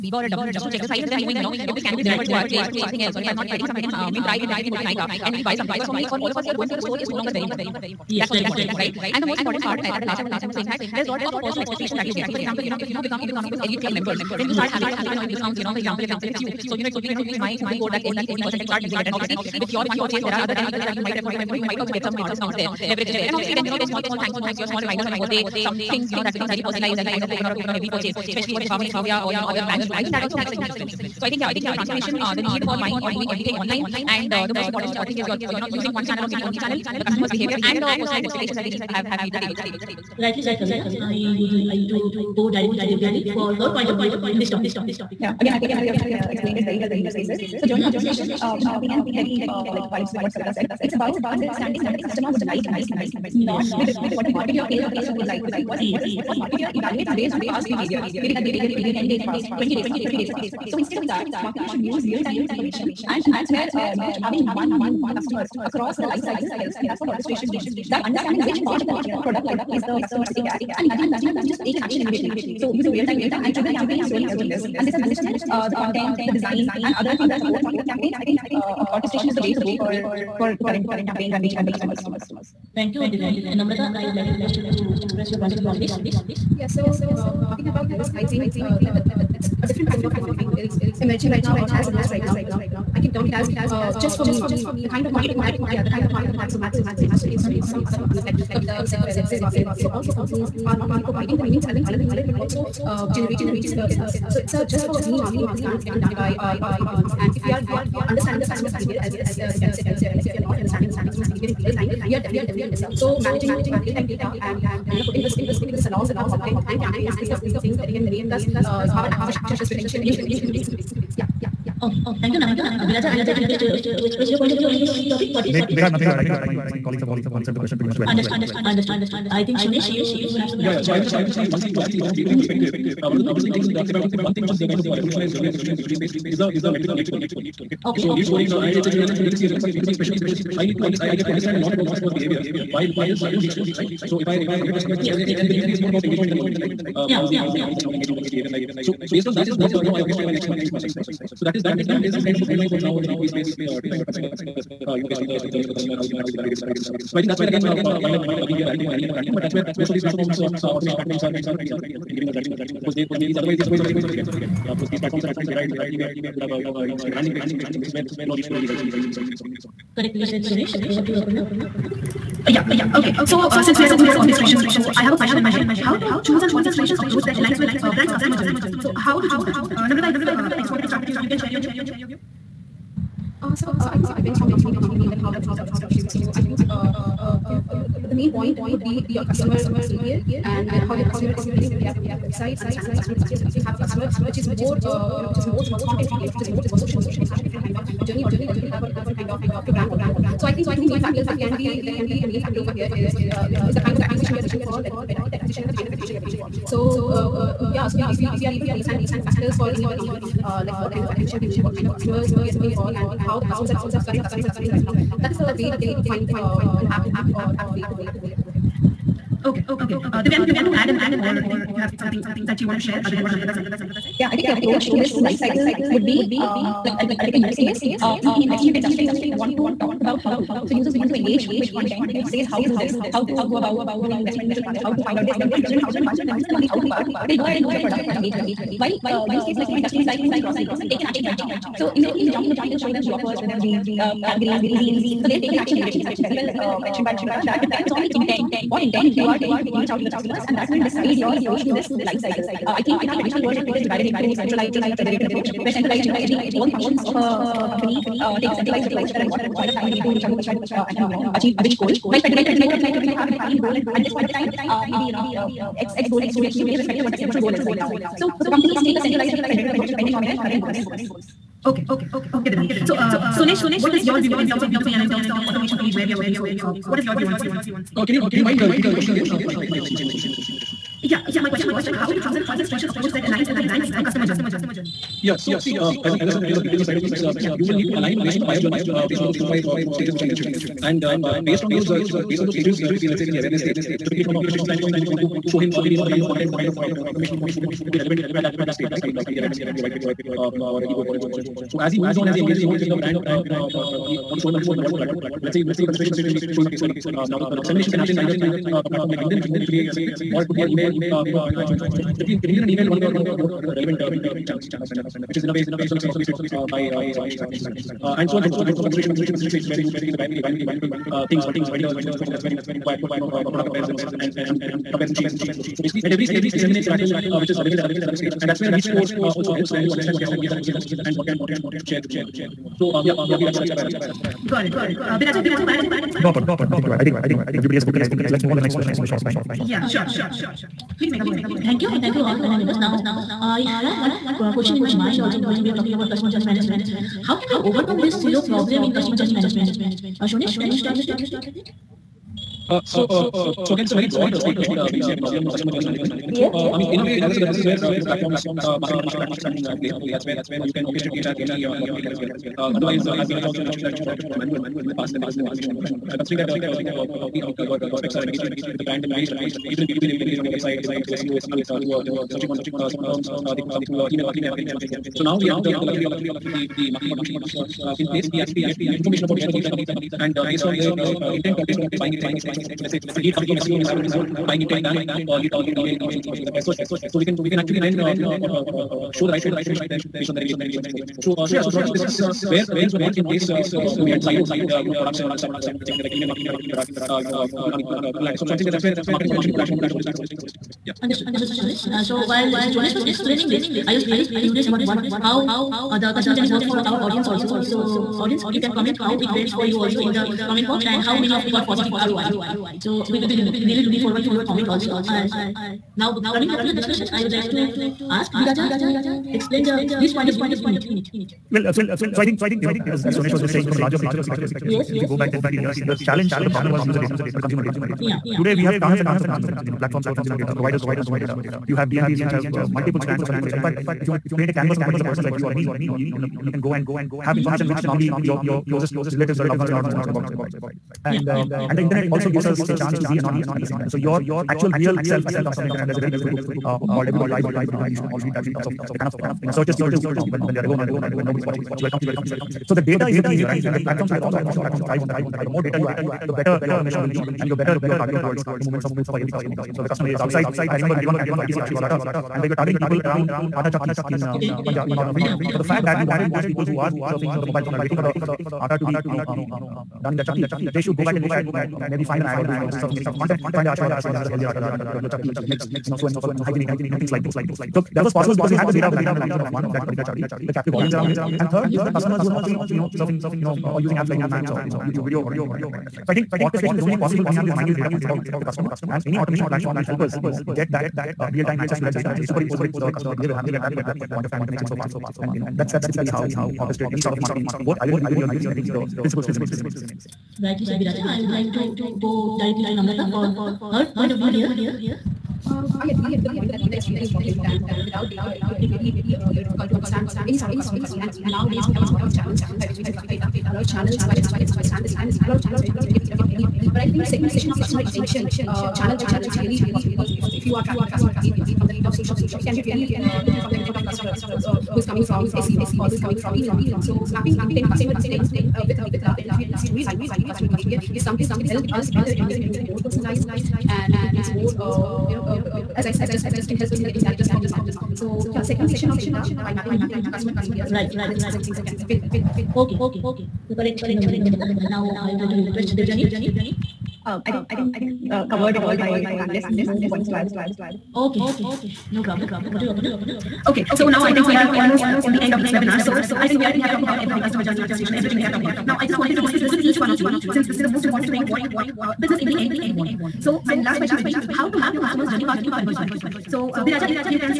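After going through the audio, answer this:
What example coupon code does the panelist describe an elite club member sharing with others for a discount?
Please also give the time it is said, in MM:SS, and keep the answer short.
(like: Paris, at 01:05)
MEG 50%, at 00:18.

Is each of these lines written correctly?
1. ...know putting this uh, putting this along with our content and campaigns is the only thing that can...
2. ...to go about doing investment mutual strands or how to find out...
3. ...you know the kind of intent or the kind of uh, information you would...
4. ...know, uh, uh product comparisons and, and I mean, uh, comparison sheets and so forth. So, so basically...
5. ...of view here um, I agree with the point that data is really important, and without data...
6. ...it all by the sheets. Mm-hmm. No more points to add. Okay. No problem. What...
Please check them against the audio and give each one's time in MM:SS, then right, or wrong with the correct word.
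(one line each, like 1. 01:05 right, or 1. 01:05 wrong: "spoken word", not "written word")
1. 01:54 right
2. 03:53 wrong: "funds", not "strands"
3. 04:55 wrong: "content", not "intent"
4. 05:23 right
5. 08:24 right
6. 09:08 wrong: "panelists", not "sheets".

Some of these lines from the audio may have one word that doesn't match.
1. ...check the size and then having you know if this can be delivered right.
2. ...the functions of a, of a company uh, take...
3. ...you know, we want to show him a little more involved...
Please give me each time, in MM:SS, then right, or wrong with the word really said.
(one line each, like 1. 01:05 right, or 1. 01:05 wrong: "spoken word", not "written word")
1. 00:00 wrong: "knowing", not "having"
2. 04:16 right
3. 05:03 right.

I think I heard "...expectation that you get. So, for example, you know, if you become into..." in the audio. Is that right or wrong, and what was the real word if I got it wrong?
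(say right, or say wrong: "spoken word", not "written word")
right.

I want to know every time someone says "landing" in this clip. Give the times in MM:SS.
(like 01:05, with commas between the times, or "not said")
02:47.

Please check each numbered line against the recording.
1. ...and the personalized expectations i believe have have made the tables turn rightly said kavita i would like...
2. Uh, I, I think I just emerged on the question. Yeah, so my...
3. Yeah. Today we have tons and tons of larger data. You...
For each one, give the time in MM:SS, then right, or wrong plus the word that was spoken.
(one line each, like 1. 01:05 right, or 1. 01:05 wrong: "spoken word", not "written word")
1. 00:37 right
2. 04:39 wrong: "missed", not "emerged"
3. 07:08 wrong: "consumer", not "larger".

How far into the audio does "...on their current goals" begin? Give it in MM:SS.
04:30.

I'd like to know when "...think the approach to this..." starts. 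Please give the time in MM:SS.
03:44.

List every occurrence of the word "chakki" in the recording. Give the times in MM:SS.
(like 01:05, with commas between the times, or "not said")
07:43, 07:50, 07:55, 08:00.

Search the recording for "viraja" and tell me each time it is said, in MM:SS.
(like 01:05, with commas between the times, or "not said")
06:58, 08:20.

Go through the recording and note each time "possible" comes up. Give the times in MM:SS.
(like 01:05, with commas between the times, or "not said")
07:58, 08:07.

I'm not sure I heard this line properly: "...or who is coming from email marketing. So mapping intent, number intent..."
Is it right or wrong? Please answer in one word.
wrong.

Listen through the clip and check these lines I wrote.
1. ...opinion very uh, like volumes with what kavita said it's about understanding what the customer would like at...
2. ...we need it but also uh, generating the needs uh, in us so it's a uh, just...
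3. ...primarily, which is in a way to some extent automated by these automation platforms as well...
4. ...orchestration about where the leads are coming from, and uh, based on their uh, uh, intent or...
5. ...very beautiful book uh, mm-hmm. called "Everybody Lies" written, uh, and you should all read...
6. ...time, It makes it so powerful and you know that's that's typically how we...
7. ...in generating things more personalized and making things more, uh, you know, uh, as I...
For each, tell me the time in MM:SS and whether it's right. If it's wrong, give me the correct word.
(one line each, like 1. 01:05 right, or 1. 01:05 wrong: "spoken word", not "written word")
1. 00:48 wrong: "vibes", not "volumes"
2. 01:41 right
3. 05:14 right
4. 06:19 wrong: "information", not "orchestration"
5. 07:26 right
6. 08:14 right
7. 08:52 wrong: "making", not "generating".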